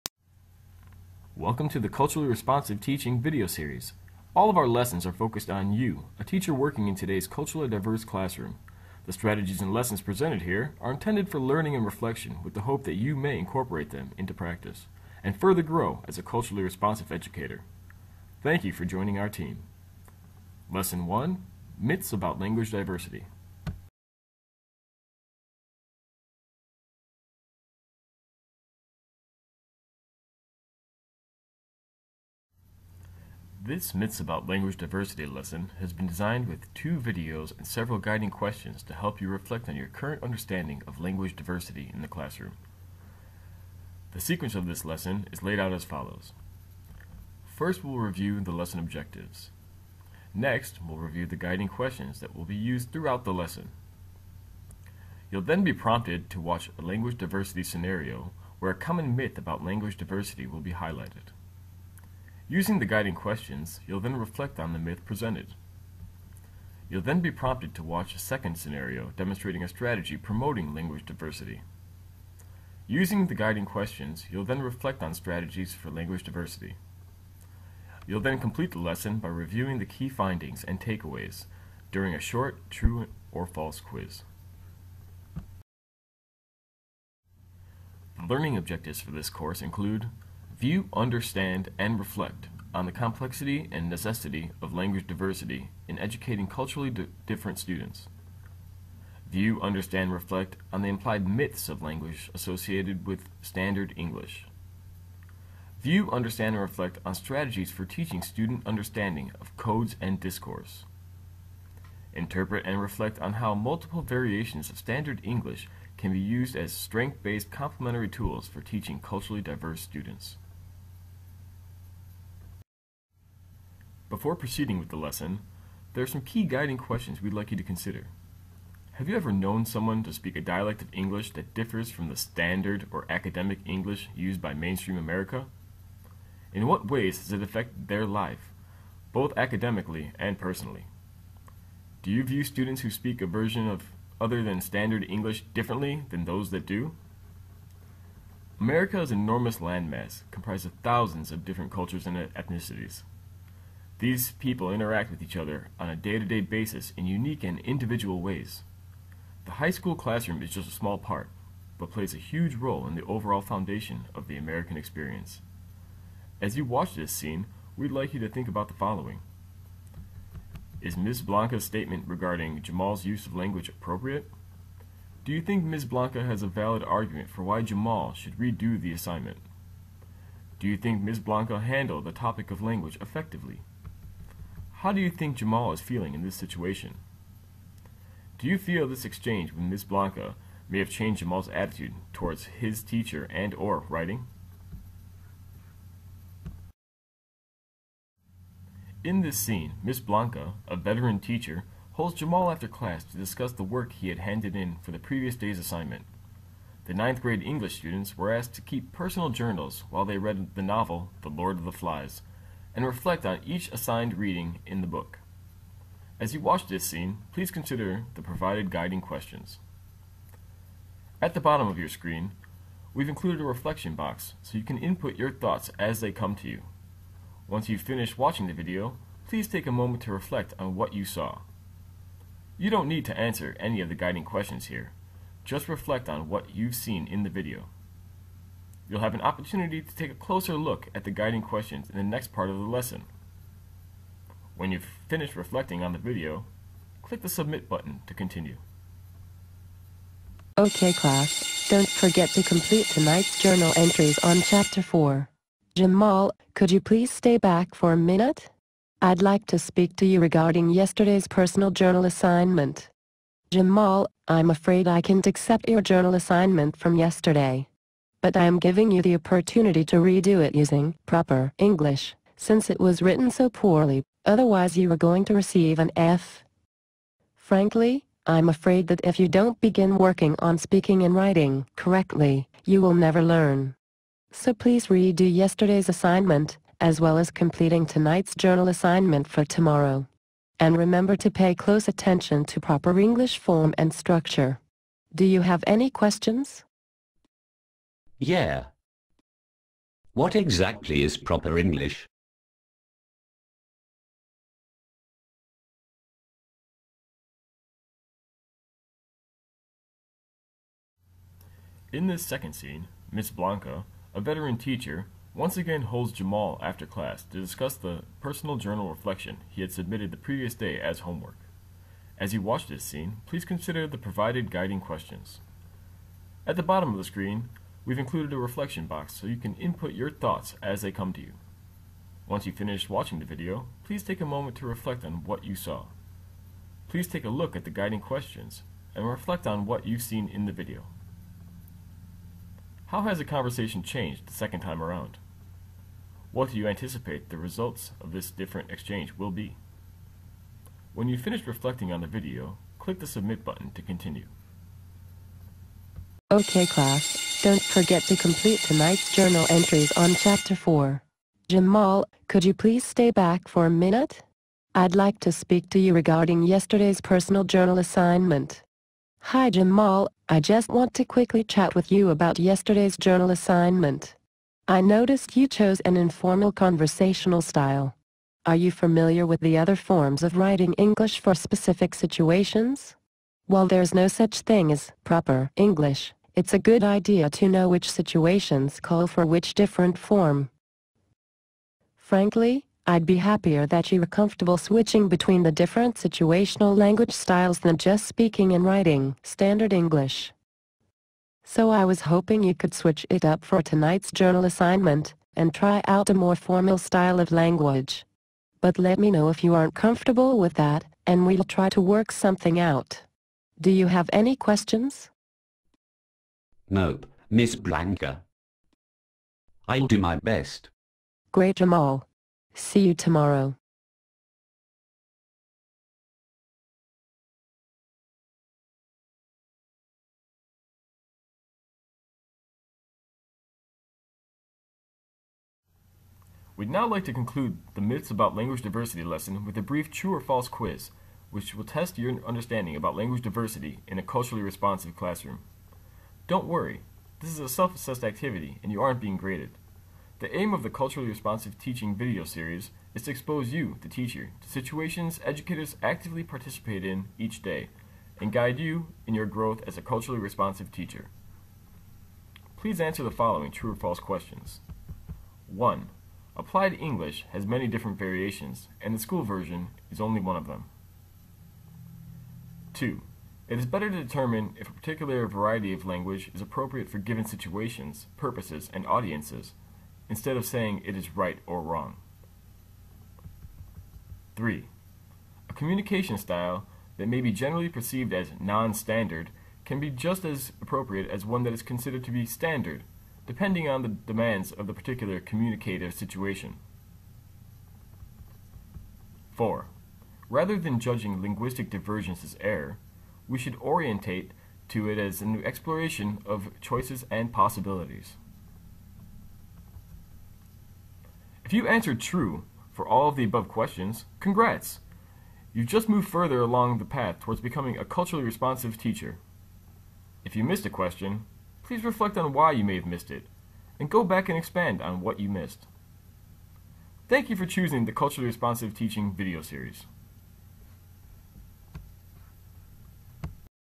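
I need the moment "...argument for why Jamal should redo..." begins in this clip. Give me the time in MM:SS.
02:56.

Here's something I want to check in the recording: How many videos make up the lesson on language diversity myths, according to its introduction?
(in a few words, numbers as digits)
2.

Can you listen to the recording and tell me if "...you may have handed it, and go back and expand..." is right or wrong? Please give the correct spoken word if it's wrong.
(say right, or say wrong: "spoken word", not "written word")
wrong: "missed", not "handed".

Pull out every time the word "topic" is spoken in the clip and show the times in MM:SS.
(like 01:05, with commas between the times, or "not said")
03:02.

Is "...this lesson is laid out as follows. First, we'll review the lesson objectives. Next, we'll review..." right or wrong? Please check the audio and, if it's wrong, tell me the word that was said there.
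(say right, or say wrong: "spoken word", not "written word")
right.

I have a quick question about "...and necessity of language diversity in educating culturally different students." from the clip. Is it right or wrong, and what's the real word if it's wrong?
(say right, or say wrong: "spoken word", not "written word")
right.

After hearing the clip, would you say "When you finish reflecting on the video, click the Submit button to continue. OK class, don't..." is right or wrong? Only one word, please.
right.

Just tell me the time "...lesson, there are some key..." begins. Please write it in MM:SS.
02:04.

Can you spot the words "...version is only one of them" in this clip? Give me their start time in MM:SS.
07:49.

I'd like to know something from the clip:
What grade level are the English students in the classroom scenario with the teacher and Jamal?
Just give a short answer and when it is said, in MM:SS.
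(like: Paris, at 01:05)
Ninth grade, at 03:26.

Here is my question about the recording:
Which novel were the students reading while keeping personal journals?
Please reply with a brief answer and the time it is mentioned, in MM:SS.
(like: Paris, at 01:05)
The Lord of the Flies, at 03:31.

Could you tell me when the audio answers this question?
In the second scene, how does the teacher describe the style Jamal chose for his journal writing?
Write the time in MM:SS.
06:15.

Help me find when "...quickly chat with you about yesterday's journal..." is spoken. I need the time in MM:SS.
06:11.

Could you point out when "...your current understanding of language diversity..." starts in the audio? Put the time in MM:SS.
00:39.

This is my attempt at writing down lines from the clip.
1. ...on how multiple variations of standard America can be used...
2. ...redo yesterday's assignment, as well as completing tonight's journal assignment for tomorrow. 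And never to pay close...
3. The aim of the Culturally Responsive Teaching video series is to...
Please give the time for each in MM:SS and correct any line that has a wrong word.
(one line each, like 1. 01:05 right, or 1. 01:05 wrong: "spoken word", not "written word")
1. 01:53 wrong: "English", not "America"
2. 04:44 wrong: "remember", not "never"
3. 07:30 right.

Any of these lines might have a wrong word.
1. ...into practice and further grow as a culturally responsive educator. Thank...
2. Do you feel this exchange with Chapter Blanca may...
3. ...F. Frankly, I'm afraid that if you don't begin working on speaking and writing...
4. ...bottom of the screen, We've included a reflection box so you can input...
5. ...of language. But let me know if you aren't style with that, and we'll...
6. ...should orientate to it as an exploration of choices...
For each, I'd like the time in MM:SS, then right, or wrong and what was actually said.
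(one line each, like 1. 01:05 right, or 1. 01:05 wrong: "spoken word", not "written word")
1. 00:14 right
2. 03:08 wrong: "Miss", not "Chapter"
3. 04:35 right
4. 05:26 right
5. 06:47 wrong: "comfortable", not "style"
6. 08:23 right.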